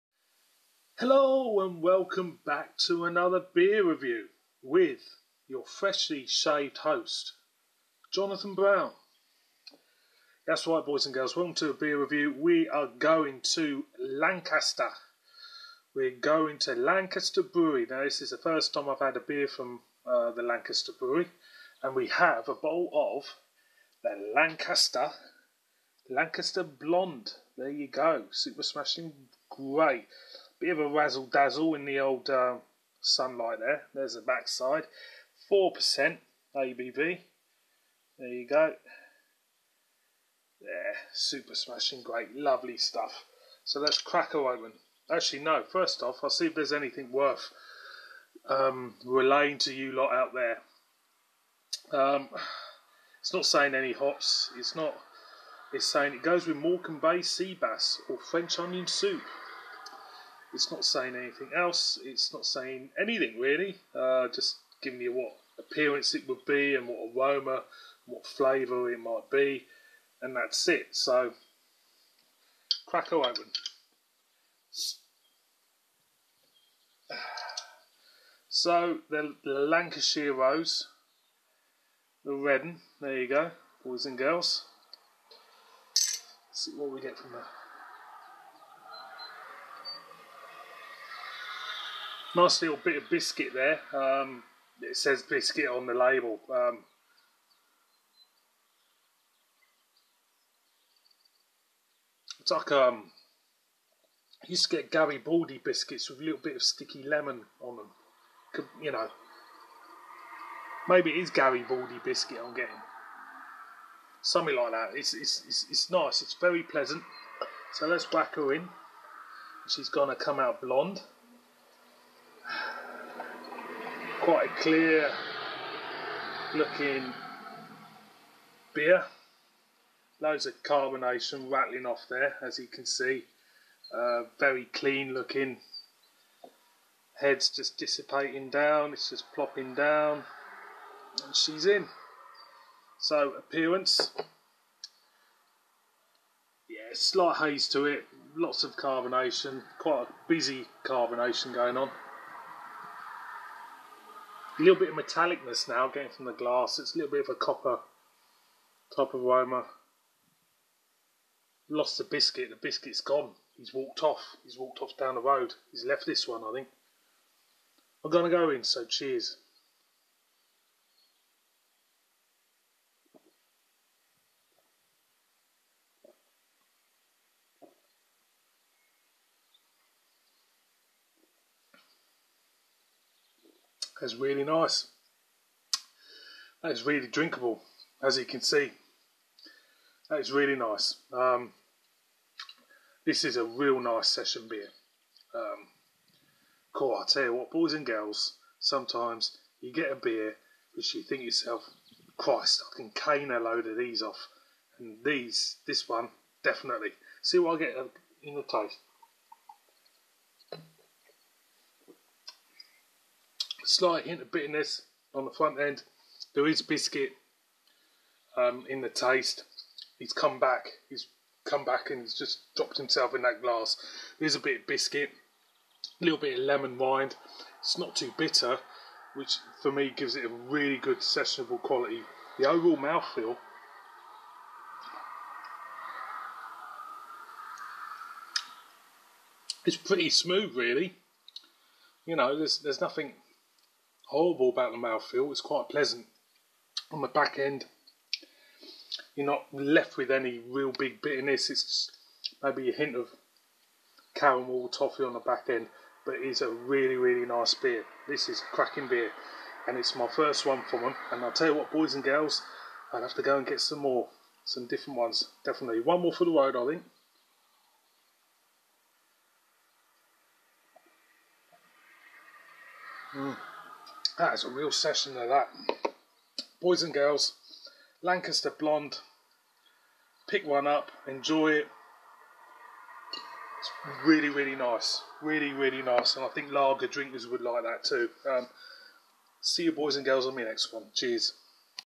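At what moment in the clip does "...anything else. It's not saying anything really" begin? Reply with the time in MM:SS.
01:01.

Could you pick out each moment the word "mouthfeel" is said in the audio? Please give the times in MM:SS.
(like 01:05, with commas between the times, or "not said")
03:52, 04:04.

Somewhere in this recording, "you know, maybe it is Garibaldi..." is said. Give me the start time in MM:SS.
01:48.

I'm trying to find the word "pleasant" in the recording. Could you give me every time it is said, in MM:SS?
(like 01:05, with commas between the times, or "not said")
01:56, 04:05.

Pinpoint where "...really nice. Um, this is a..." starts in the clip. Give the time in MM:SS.
03:10.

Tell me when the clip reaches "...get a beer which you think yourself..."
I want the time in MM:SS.
03:19.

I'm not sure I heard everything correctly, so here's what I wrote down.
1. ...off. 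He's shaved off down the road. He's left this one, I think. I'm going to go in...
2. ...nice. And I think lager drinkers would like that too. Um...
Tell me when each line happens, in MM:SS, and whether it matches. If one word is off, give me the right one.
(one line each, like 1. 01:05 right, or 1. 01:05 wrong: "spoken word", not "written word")
1. 02:44 wrong: "walked", not "shaved"
2. 04:45 right.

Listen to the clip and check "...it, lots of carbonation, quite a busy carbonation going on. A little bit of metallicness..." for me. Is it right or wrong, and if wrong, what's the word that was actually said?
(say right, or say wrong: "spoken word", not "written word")
right.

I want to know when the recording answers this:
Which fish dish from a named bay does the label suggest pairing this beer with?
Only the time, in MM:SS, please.
00:56.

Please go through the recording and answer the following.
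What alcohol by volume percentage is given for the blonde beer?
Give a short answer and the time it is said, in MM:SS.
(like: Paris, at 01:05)
4%, at 00:35.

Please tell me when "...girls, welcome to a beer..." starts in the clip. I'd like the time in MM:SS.
00:11.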